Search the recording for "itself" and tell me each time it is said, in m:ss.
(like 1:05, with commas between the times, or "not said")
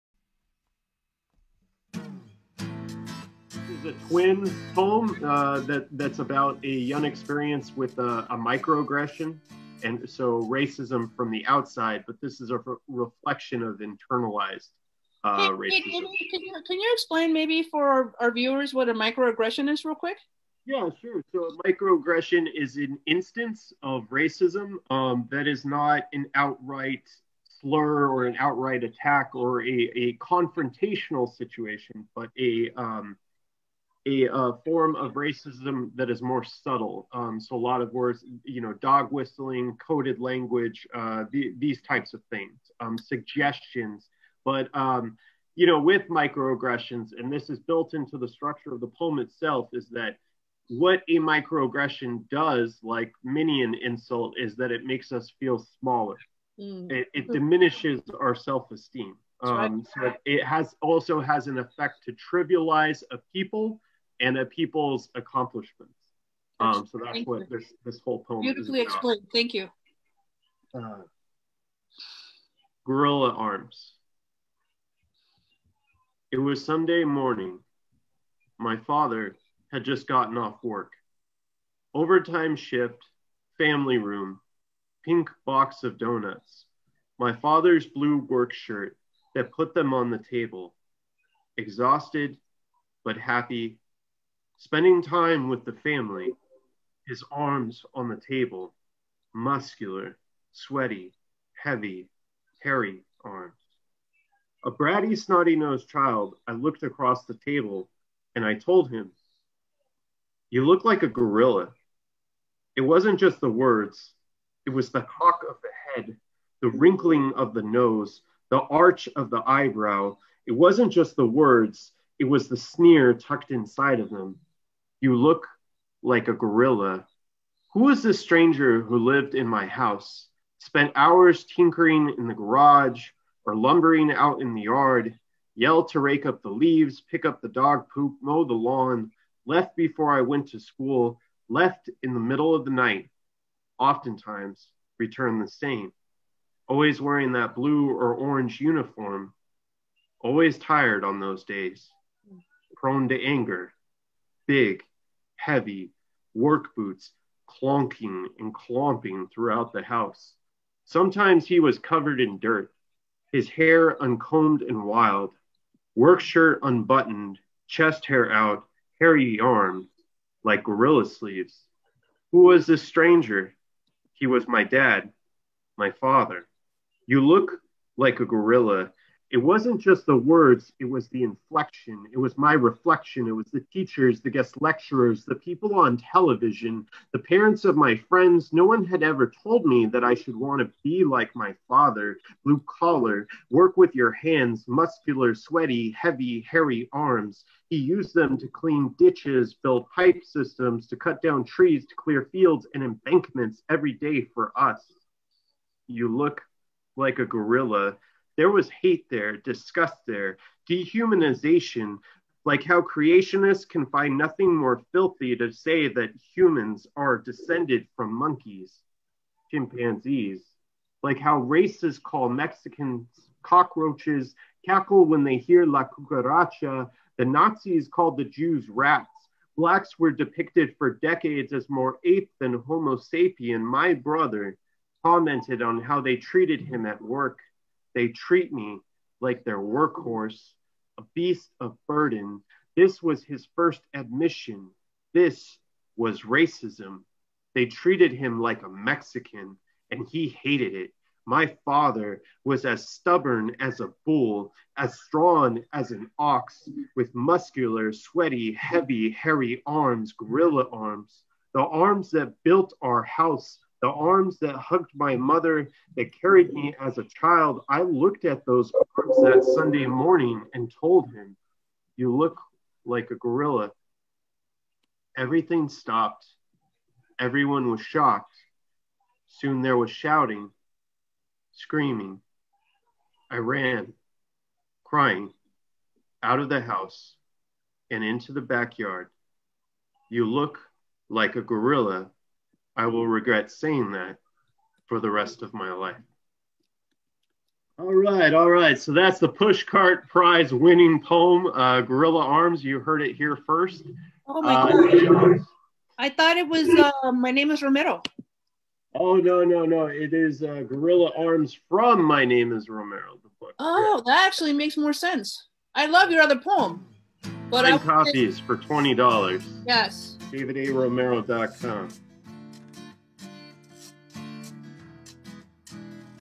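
0:49.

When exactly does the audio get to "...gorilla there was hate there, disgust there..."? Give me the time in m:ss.
3:27.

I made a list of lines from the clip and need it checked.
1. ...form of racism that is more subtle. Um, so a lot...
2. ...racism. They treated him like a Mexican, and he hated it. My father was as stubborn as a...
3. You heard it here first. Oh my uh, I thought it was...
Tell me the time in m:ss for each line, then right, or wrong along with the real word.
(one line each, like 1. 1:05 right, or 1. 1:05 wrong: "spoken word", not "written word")
1. 0:34 right
2. 4:06 right
3. 5:02 right.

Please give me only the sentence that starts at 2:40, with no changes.
Sometimes he was covered in dirt, his hair uncombed and wild, work shirt unbuttoned, chest hair out, hairy arms like gorilla sleeves.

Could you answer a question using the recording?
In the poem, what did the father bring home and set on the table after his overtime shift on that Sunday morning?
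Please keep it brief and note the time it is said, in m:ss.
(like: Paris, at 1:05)
Pink box of donuts, at 1:25.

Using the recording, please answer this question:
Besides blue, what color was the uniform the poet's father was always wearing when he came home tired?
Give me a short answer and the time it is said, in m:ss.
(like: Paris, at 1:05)
Orange, at 2:28.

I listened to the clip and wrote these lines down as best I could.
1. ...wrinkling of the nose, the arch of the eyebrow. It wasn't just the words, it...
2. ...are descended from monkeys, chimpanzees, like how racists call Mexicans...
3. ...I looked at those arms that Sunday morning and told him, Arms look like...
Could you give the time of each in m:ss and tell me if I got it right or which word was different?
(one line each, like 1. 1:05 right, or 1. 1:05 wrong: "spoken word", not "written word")
1. 1:56 right
2. 3:36 right
3. 4:27 wrong: "You", not "Arms".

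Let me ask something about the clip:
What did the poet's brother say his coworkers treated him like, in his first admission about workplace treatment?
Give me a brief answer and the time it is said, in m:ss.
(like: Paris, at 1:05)
Their workhorse, at 3:59.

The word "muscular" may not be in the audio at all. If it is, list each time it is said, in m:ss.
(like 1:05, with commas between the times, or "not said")
1:39, 3:14, 4:17.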